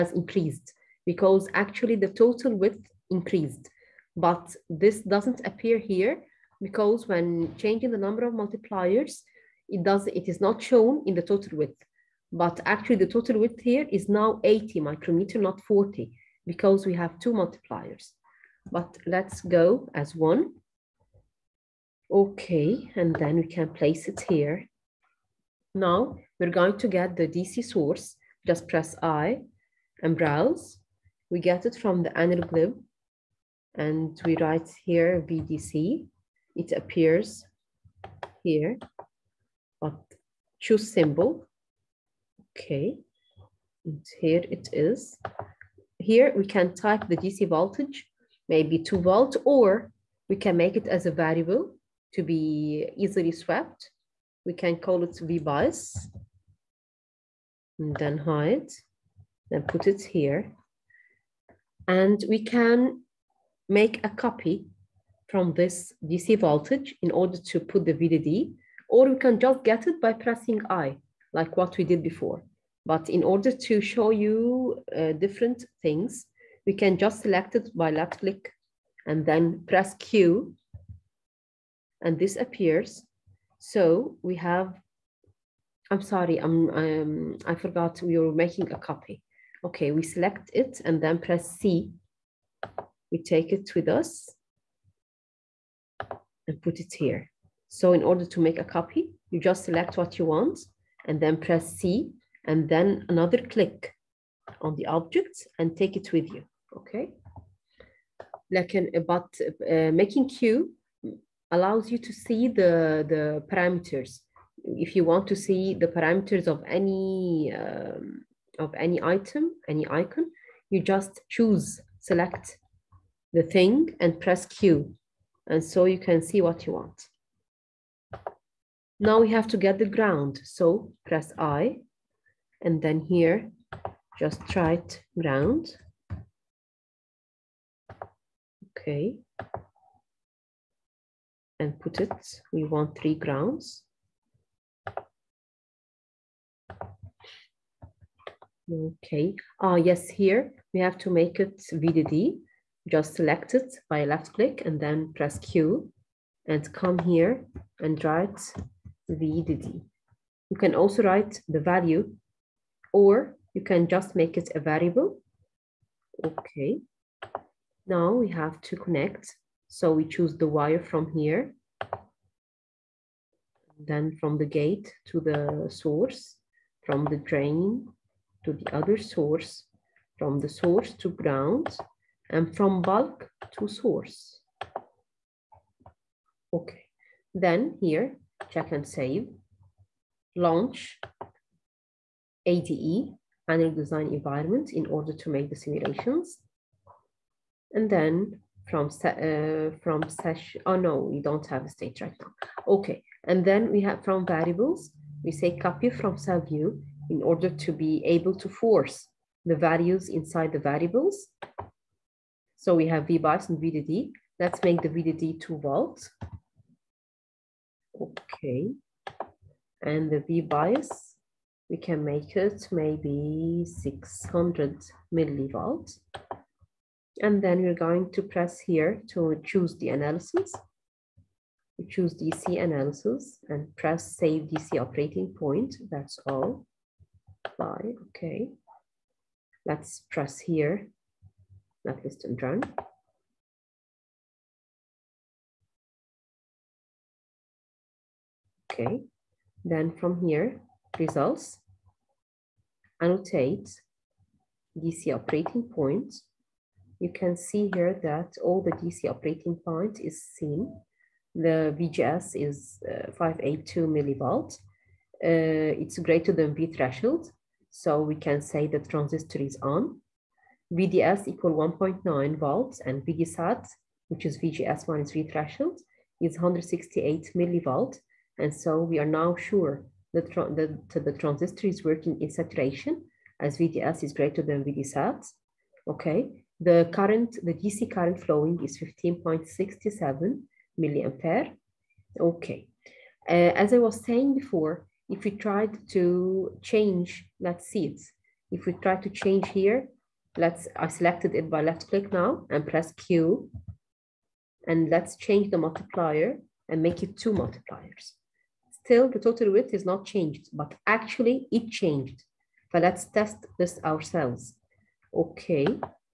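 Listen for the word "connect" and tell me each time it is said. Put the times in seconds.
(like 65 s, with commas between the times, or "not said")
168 s.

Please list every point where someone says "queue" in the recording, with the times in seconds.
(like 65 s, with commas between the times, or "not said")
110 s.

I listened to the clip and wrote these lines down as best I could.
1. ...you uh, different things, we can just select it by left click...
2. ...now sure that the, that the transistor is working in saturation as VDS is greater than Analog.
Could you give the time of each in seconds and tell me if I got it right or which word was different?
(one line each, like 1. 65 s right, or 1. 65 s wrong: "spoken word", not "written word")
1. 74 s right
2. 279 s wrong: "VDSAT", not "Analog".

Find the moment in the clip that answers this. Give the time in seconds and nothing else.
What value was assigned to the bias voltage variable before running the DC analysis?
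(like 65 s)
223 s.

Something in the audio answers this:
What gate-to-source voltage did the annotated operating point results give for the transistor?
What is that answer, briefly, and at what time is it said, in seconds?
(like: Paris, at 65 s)
582 millivolts, at 263 s.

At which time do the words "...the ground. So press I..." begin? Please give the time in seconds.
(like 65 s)
129 s.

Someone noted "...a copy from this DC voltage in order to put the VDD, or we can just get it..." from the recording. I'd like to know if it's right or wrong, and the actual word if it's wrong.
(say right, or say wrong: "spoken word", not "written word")
right.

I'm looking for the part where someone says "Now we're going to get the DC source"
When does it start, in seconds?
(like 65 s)
25 s.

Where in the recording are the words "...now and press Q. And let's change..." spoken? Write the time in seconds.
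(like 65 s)
302 s.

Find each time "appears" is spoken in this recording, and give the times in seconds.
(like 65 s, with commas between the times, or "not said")
5 s, 36 s, 82 s.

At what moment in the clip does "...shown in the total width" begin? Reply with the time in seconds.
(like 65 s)
10 s.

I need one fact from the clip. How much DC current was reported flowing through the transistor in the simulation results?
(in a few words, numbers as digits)
15.67 milliamperes.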